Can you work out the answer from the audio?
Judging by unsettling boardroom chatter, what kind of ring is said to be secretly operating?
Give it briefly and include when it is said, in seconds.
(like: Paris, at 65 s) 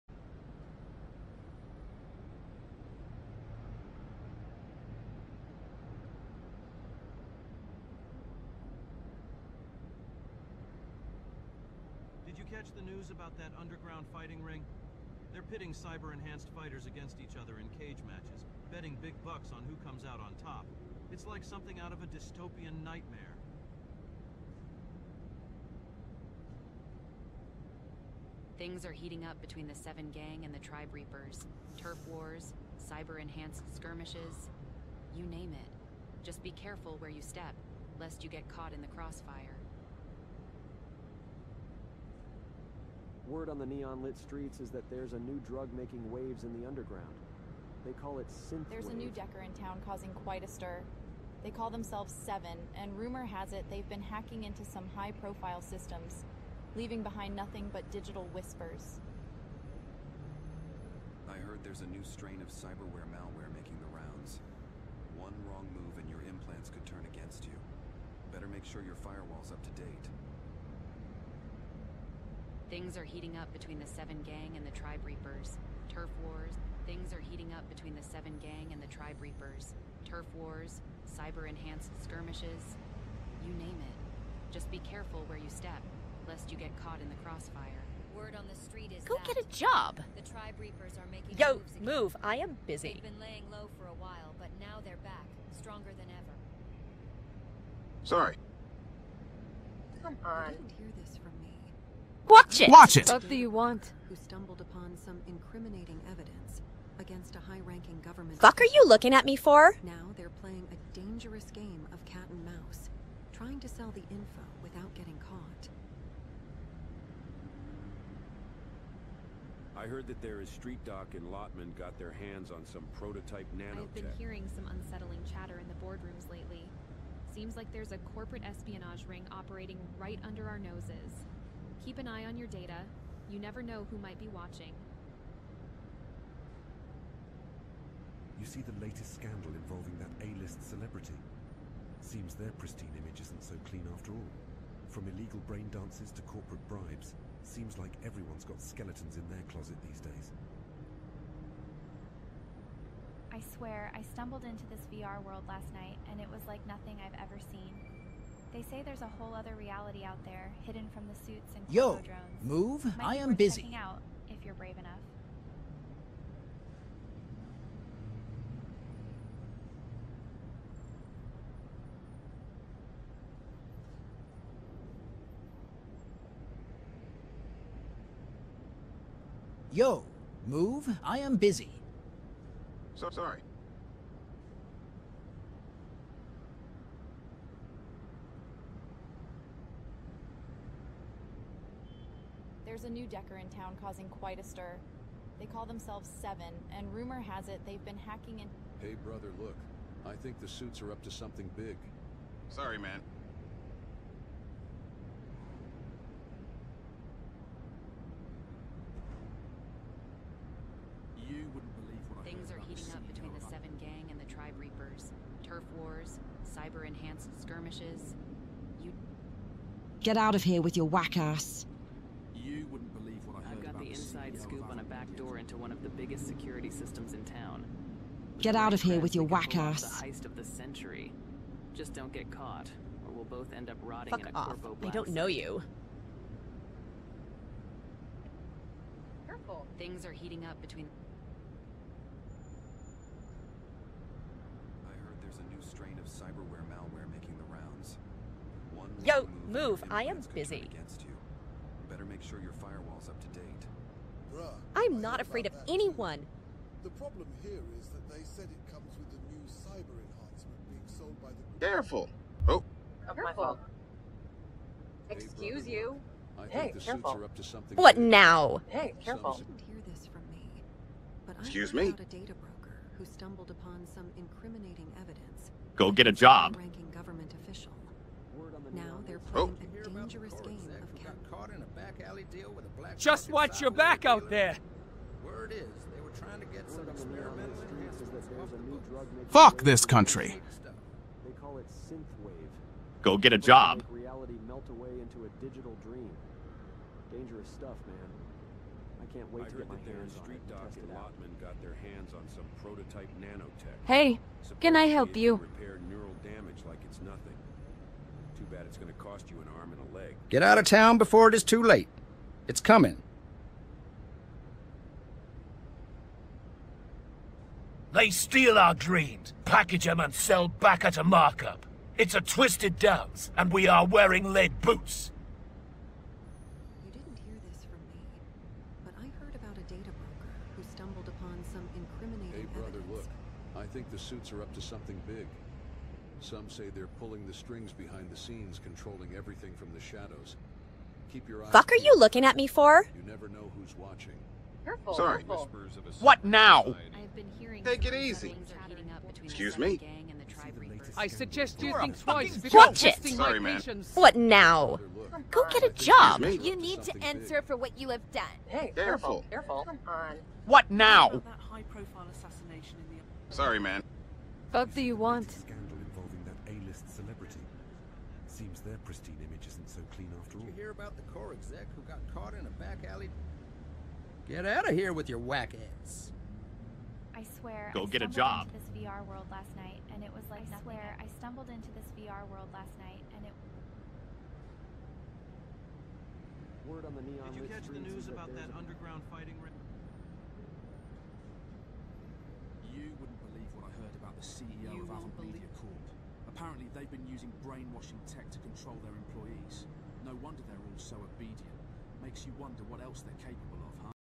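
corporate espionage ring, at 128 s.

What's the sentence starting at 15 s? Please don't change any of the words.
They're pitting cyber-enhanced fighters against each other in cage matches, betting big bucks on who comes out on top.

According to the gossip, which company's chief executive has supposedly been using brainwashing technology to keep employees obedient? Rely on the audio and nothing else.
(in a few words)
Avon Media Corp.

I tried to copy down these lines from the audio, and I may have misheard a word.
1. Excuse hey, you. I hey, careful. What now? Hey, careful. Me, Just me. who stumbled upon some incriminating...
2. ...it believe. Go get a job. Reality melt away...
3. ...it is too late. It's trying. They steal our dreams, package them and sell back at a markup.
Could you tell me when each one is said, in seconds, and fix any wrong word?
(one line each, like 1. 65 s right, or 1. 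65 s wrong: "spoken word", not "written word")
1. 265 s wrong: "Excuse", not "Just"
2. 291 s wrong: "synthwave", not "believe"
3. 311 s wrong: "coming", not "trying".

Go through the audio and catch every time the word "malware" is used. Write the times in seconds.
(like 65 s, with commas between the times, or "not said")
63 s, 246 s.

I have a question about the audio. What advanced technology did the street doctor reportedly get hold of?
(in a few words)
prototype nanotech.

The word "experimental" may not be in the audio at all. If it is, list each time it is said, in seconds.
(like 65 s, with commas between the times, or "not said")
286 s.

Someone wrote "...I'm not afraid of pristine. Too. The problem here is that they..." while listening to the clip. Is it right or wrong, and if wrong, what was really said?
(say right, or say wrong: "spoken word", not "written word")
wrong: "anyone", not "pristine".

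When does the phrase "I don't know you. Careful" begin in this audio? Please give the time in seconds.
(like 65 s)
234 s.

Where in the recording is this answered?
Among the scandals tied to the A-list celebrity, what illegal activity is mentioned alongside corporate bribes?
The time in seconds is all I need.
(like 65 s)
145 s.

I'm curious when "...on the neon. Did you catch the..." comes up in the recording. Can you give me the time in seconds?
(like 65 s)
386 s.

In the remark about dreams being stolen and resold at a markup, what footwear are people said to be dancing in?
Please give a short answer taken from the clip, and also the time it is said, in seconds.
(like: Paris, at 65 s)
lead boots, at 324 s.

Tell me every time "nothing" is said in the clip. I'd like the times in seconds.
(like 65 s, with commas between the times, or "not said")
57 s, 156 s.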